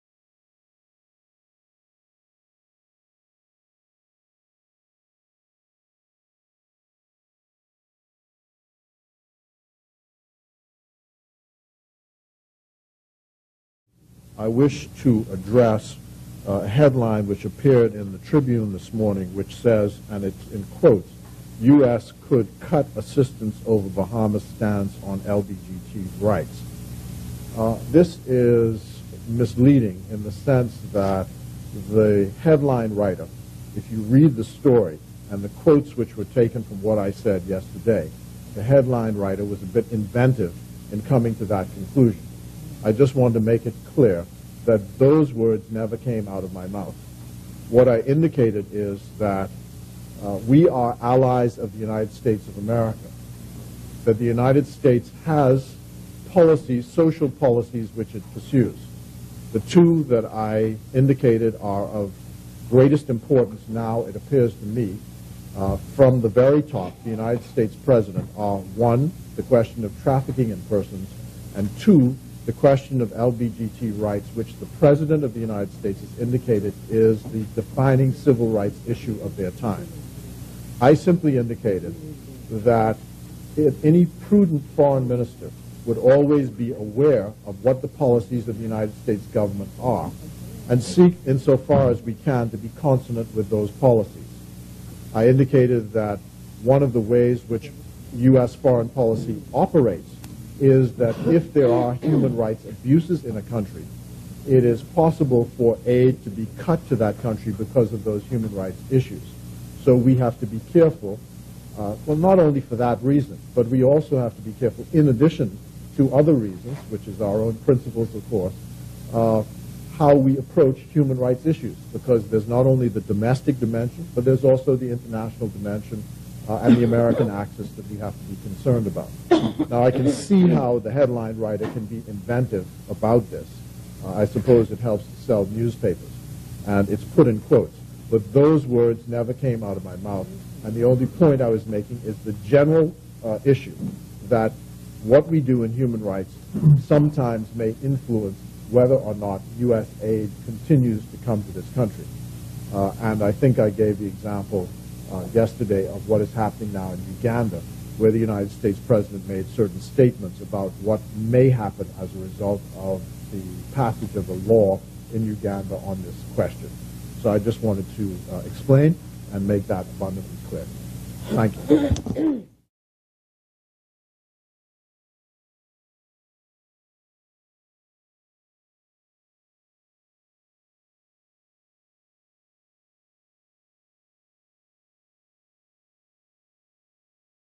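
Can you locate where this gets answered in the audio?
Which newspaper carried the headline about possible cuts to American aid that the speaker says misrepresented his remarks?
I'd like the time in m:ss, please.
0:18.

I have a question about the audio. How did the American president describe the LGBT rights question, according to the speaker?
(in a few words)
The defining civil rights issue of their time.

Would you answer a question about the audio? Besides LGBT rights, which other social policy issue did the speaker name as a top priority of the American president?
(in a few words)
Trafficking in persons.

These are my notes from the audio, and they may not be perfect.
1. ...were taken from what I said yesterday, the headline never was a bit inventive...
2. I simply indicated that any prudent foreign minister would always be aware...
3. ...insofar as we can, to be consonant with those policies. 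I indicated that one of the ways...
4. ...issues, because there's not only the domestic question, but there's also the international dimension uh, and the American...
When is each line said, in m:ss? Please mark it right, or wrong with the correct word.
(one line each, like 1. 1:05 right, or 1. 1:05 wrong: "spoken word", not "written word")
1. 0:36 wrong: "writer", not "never"
2. 1:20 right
3. 1:31 right
4. 2:01 wrong: "dimension", not "question".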